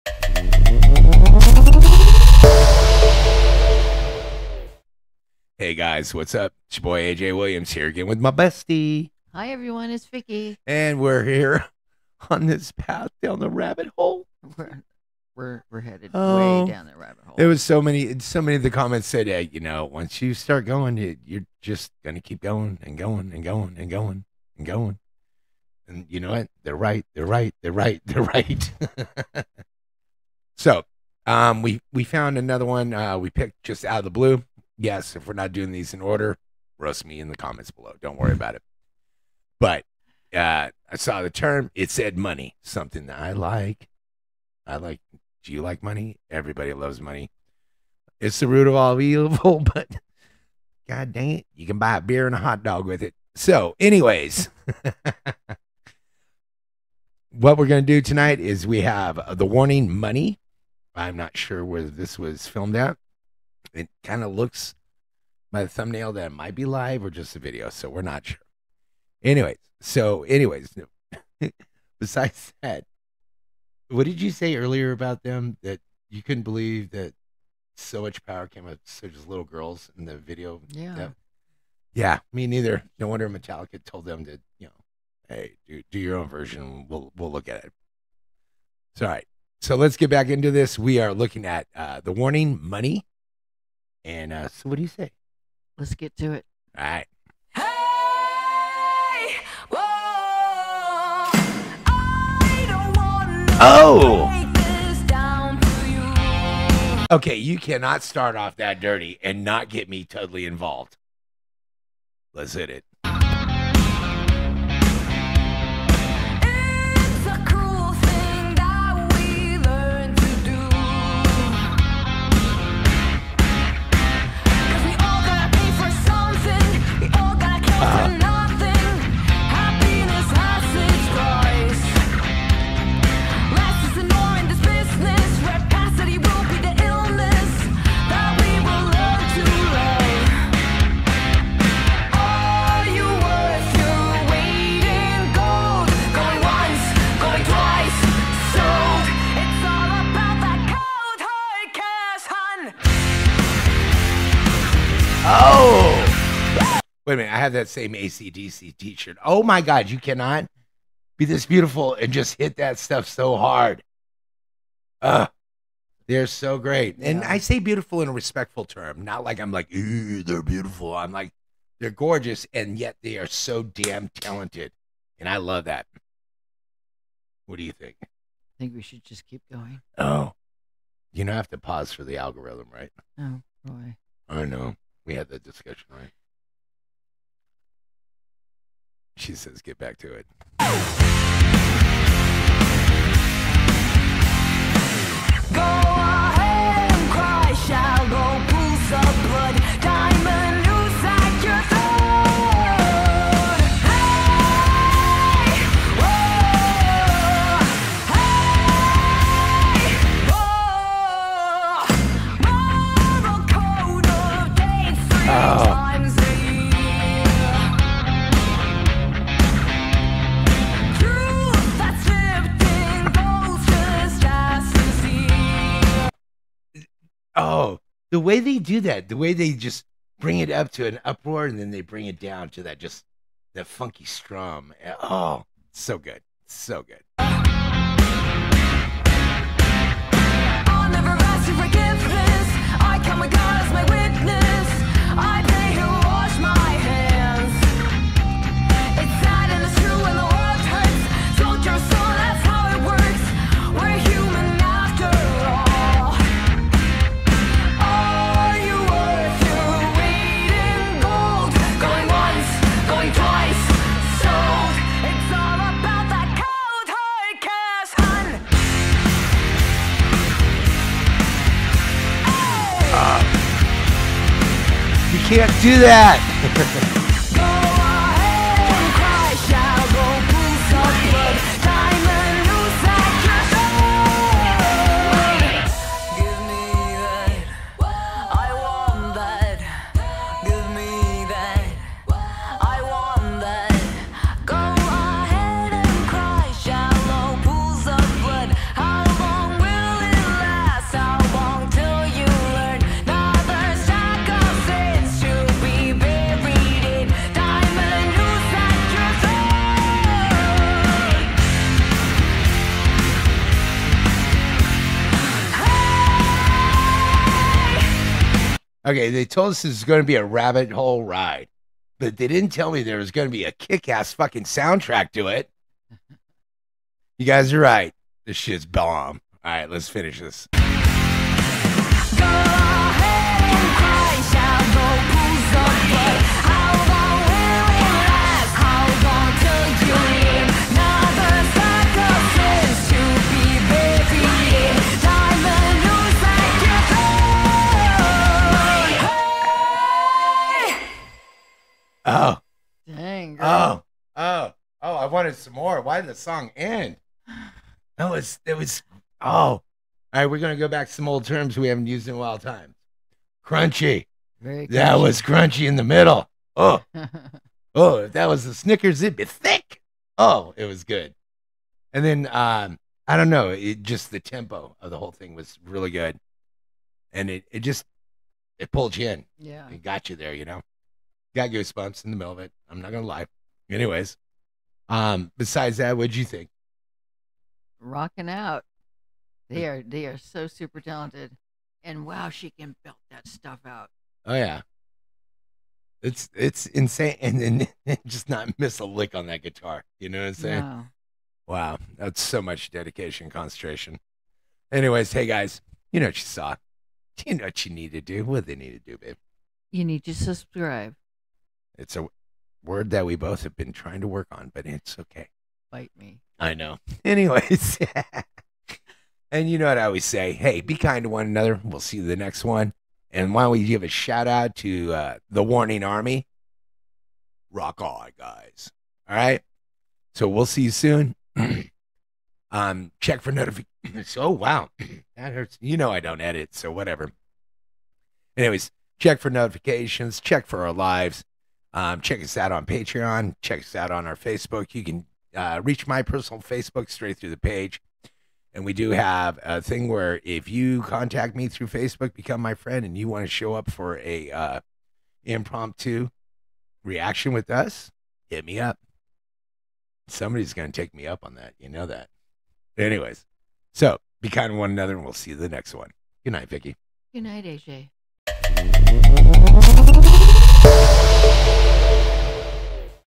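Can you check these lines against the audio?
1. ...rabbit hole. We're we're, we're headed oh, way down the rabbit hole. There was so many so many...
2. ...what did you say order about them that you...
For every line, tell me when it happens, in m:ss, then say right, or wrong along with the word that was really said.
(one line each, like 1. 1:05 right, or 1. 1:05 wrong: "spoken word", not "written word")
1. 0:13 right
2. 1:13 wrong: "earlier", not "order".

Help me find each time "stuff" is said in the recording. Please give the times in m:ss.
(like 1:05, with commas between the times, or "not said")
2:42, 6:33.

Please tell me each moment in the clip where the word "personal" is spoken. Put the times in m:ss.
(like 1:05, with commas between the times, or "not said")
7:26.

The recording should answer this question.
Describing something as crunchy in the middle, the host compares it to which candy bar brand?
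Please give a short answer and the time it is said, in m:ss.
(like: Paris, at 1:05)
Snickers, at 6:08.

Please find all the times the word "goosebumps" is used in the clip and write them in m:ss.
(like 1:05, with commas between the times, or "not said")
6:21.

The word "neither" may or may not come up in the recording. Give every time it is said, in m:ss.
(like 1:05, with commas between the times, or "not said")
1:22.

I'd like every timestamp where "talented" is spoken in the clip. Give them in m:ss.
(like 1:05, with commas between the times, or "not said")
2:54, 6:30.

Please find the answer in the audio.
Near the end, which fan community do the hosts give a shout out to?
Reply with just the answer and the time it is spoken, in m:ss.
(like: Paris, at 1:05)
Warning Army, at 7:05.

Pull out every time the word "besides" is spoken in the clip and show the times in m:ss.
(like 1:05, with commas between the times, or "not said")
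1:11, 6:25.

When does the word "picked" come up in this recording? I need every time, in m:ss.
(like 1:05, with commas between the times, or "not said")
0:33.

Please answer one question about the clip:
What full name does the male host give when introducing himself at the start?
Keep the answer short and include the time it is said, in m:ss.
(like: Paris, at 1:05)
AJ Williams, at 0:07.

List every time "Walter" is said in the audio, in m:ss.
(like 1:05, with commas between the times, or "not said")
not said.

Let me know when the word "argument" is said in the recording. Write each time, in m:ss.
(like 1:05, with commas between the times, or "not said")
not said.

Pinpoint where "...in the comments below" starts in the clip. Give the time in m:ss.
0:37.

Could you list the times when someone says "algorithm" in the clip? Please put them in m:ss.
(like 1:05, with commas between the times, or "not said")
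3:02.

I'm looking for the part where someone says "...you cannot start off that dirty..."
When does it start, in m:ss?
1:47.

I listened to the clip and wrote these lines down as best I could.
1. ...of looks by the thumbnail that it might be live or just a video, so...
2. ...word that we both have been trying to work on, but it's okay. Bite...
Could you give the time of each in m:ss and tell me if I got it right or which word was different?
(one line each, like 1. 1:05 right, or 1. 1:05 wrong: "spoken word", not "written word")
1. 1:04 right
2. 6:52 right.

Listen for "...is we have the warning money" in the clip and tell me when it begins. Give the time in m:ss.
0:58.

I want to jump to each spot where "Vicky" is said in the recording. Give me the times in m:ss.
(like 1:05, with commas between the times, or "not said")
0:10, 7:46.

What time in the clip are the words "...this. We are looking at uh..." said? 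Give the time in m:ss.
1:30.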